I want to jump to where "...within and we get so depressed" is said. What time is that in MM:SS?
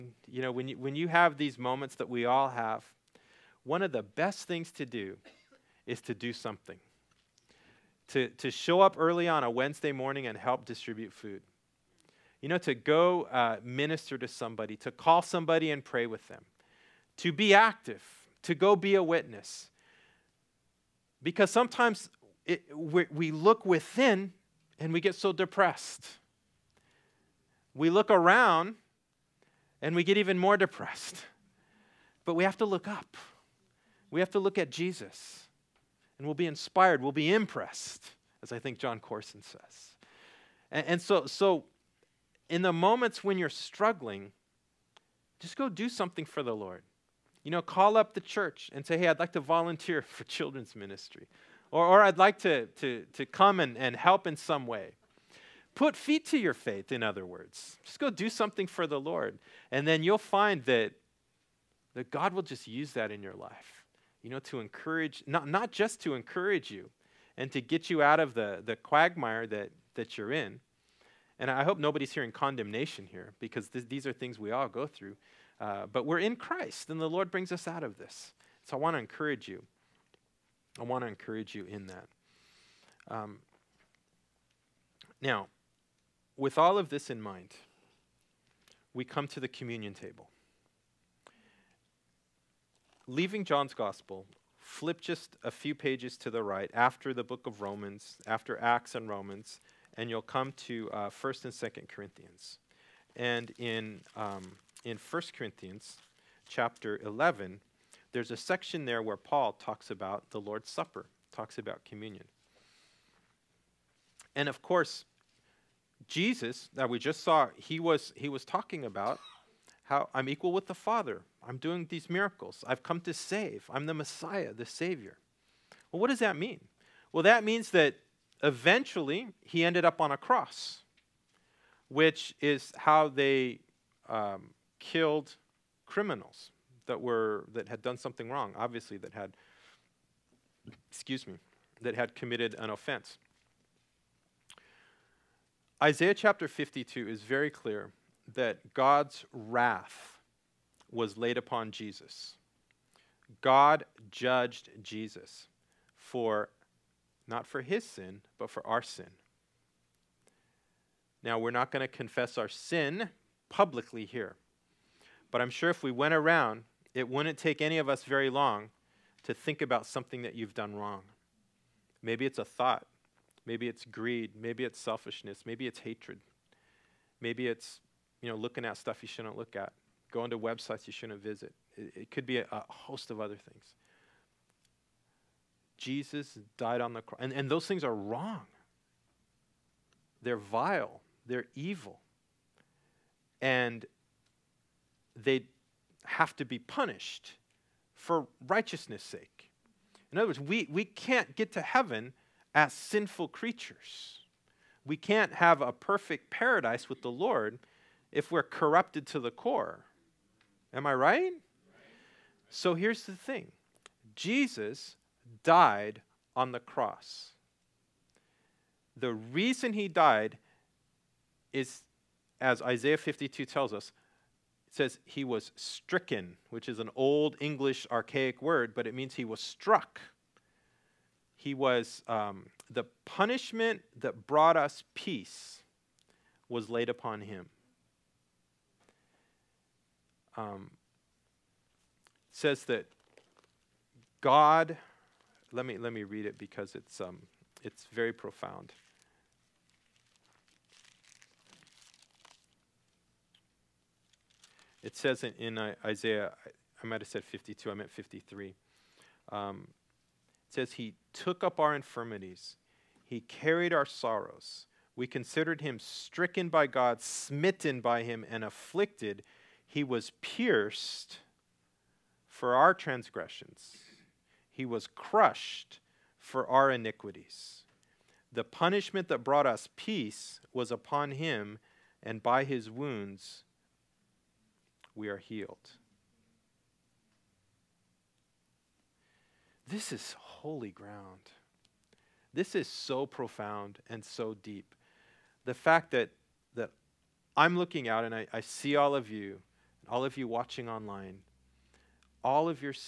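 00:23.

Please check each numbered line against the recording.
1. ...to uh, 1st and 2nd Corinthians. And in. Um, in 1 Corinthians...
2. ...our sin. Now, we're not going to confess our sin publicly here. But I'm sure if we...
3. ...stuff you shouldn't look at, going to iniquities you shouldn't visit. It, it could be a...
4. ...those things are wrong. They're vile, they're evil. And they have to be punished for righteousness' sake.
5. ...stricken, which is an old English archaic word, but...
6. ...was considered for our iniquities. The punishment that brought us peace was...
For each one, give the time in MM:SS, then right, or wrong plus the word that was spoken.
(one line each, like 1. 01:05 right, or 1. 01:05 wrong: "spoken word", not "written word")
1. 01:40 right
2. 02:38 right
3. 02:58 wrong: "websites", not "iniquities"
4. 03:07 right
5. 03:45 right
6. 04:34 wrong: "crushed", not "considered".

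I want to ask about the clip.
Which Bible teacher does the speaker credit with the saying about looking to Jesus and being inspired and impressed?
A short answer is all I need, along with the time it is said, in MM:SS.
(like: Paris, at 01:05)
Jon Courson, at 00:38.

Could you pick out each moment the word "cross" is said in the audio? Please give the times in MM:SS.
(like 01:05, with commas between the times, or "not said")
02:10, 03:07, 03:36.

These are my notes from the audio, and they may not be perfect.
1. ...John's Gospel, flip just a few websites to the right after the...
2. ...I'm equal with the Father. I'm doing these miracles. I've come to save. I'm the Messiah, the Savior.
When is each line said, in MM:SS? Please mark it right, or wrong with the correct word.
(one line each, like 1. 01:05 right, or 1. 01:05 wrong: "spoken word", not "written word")
1. 01:33 wrong: "pages", not "websites"
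2. 02:00 right.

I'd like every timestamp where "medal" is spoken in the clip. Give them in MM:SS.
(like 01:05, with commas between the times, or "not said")
not said.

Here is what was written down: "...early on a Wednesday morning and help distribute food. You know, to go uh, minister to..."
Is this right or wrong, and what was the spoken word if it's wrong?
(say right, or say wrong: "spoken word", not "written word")
right.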